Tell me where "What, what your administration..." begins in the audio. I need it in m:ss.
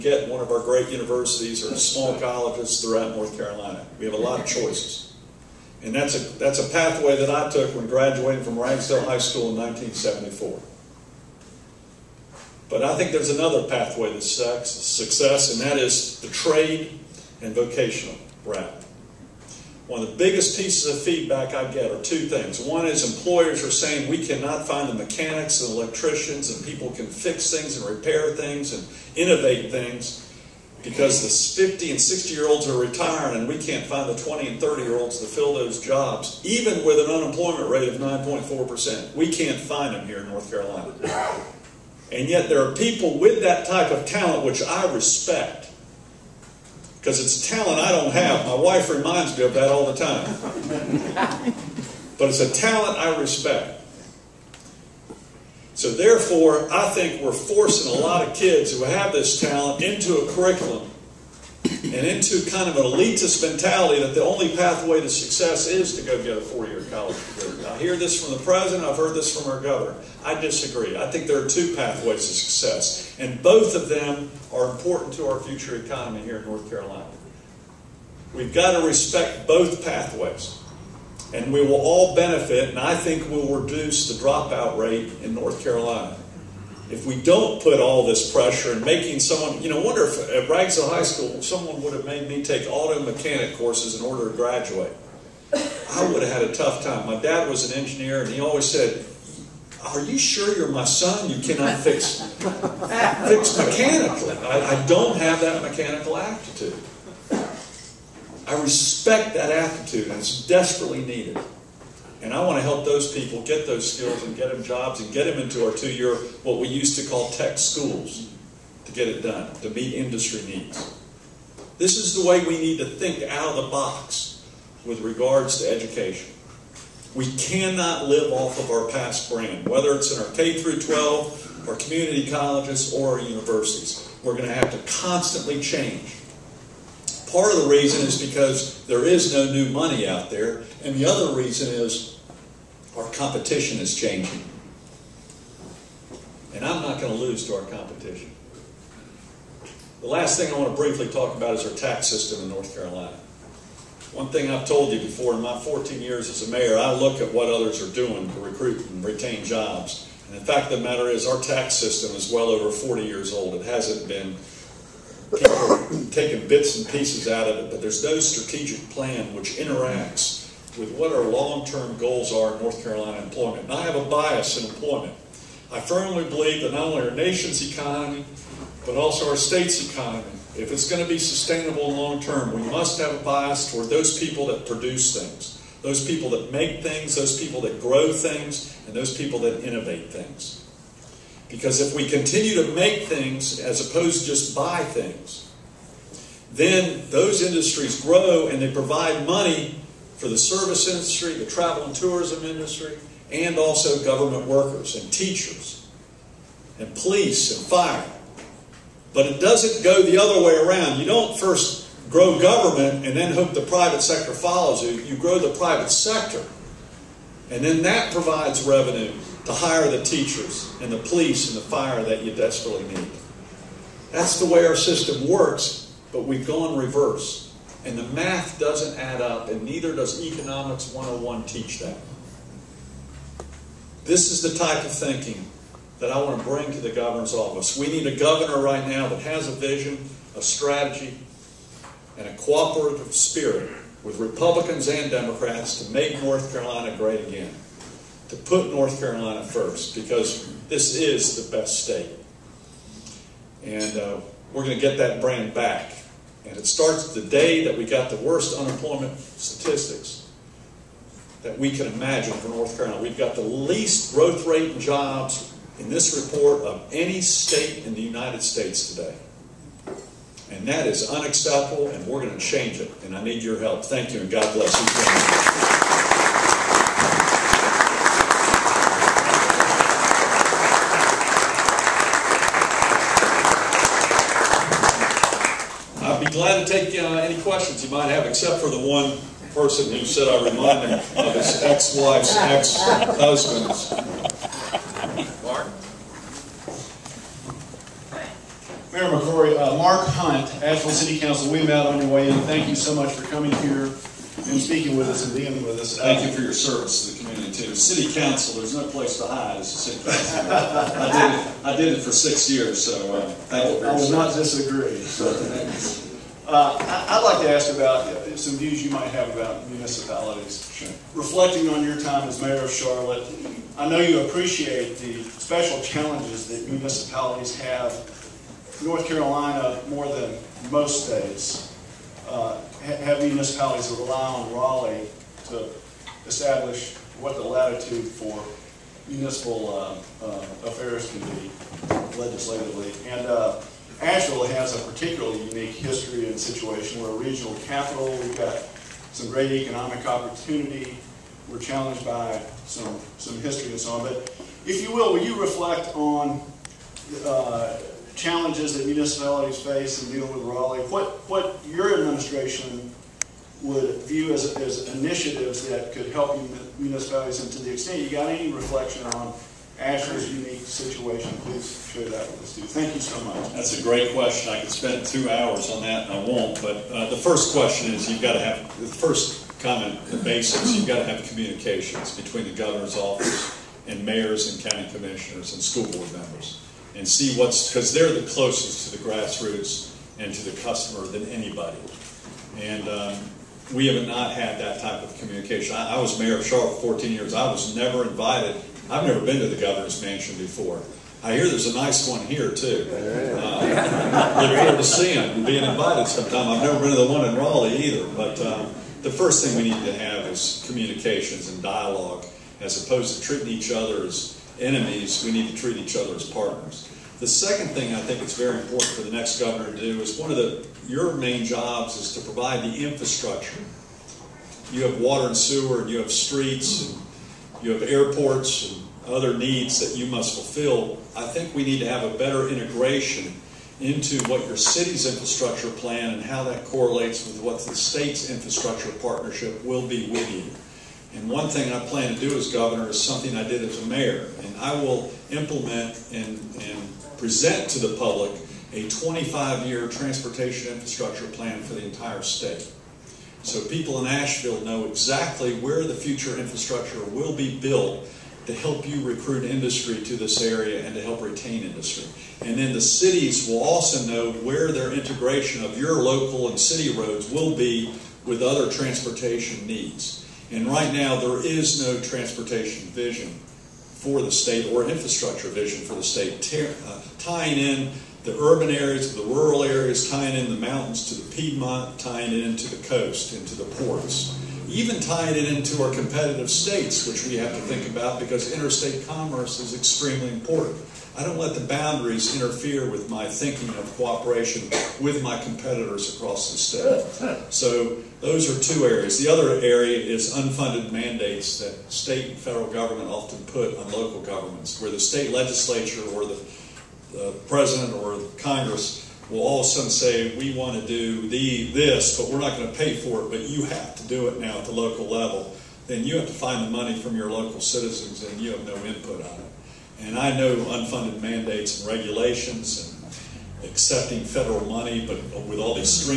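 6:00.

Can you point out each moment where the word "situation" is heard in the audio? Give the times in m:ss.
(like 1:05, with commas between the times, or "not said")
5:46, 6:10.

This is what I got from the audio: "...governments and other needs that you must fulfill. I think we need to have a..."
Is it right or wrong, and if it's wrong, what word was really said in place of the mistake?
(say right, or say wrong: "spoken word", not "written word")
wrong: "airports", not "governments".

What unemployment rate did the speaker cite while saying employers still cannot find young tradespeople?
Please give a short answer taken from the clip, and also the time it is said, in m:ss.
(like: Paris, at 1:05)
9.4%, at 0:37.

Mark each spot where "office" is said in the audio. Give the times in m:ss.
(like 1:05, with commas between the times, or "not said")
3:57, 6:22.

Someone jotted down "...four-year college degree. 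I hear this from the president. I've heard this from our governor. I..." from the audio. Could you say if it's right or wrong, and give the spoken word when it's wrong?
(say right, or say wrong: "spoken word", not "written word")
right.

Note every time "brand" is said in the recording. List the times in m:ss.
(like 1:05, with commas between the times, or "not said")
2:09, 4:15.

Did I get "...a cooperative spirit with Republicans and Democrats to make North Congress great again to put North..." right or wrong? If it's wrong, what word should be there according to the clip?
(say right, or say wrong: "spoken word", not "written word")
wrong: "Carolina", not "Congress".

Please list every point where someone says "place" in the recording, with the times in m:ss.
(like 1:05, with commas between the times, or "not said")
5:08.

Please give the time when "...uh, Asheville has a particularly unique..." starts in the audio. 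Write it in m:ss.
5:43.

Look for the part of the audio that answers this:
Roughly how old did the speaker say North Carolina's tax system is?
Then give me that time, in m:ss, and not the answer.
2:42.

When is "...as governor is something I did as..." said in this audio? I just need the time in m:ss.
7:22.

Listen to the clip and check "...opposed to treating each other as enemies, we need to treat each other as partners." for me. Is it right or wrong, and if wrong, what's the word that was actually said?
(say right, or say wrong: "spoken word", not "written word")
right.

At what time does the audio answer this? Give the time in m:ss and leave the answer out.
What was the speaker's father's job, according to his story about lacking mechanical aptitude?
1:37.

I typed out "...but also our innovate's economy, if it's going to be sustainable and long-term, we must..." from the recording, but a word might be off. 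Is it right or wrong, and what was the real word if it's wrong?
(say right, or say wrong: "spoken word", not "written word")
wrong: "state", not "innovate".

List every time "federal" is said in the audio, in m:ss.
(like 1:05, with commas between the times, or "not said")
8:22, 8:44.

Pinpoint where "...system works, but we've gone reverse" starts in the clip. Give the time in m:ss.
3:44.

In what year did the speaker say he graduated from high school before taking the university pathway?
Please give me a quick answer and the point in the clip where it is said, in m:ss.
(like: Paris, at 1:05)
1974, at 0:09.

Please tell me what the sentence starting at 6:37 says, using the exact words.
I was never invited I've never been to the governor's mansion before.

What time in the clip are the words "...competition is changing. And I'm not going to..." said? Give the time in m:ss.
2:23.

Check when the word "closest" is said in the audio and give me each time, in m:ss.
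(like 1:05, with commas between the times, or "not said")
6:28.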